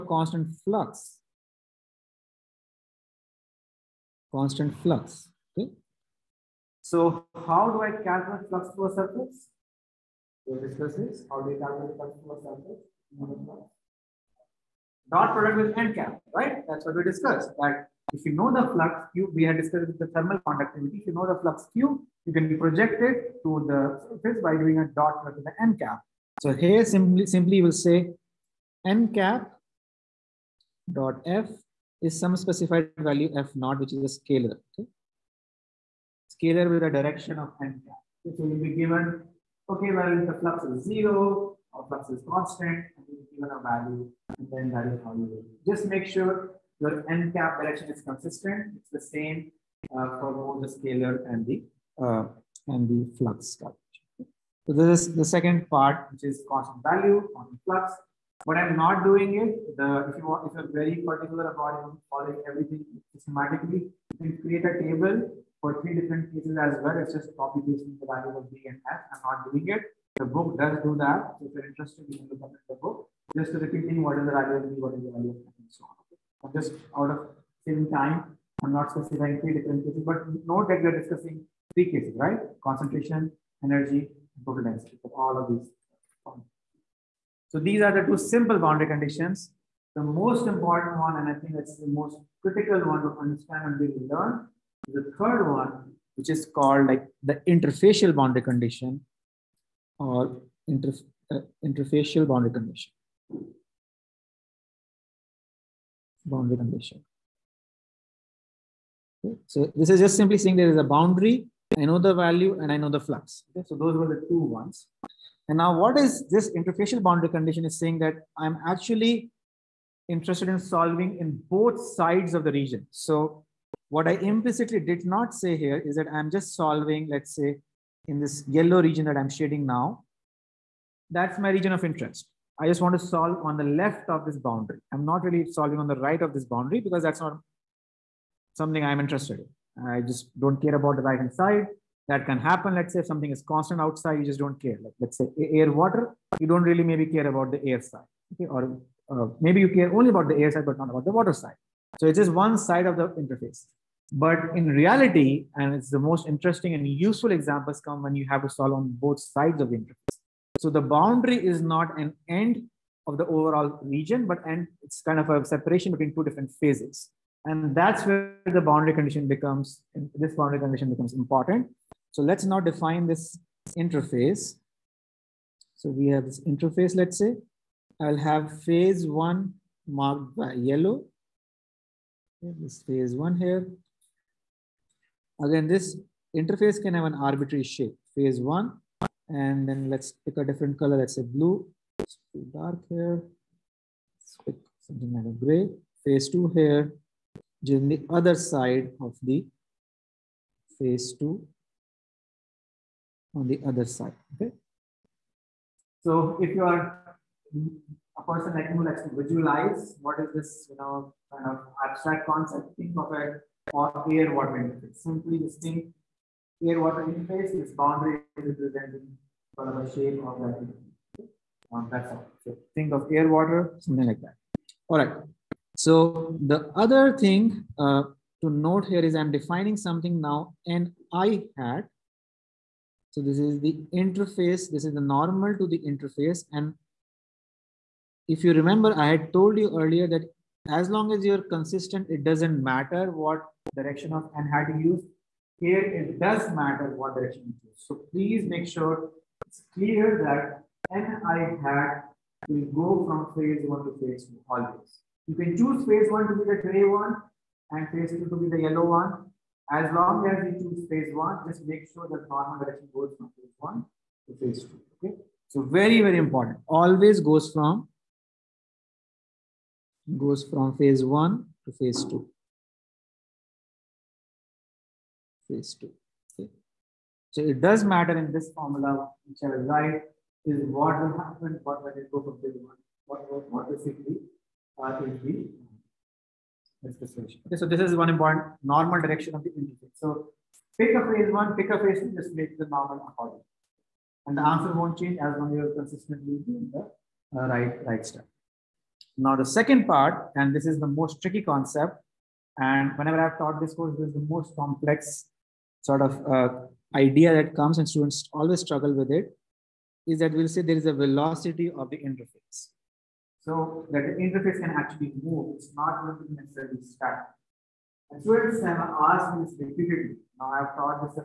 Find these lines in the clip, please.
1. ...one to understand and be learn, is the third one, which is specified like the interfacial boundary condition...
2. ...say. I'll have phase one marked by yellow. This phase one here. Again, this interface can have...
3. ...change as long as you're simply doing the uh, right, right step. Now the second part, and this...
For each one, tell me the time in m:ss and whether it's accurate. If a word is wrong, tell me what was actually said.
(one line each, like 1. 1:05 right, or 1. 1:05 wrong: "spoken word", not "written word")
1. 1:32 wrong: "called", not "specified"
2. 2:57 right
3. 4:54 wrong: "consistently", not "simply".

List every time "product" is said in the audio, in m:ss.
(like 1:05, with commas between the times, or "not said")
0:15, 0:25.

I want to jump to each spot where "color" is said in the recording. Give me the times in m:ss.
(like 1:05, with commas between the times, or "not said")
3:10.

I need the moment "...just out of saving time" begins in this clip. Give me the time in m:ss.
1:16.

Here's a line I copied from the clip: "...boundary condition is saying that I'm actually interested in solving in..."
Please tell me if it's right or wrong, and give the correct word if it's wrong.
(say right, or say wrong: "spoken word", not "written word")
right.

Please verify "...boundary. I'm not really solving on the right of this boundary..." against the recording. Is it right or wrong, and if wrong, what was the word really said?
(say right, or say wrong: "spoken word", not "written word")
right.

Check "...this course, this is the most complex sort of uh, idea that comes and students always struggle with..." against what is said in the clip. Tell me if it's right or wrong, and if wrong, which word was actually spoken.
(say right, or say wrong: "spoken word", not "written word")
right.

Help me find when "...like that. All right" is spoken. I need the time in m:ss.
3:44.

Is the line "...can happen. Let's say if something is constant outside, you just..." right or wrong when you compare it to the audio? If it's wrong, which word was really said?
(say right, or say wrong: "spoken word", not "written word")
right.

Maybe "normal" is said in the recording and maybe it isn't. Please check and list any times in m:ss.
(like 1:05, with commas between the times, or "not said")
3:55, 4:22, 4:48, 4:52.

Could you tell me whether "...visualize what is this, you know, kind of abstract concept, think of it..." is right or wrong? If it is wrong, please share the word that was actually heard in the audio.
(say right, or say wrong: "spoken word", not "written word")
right.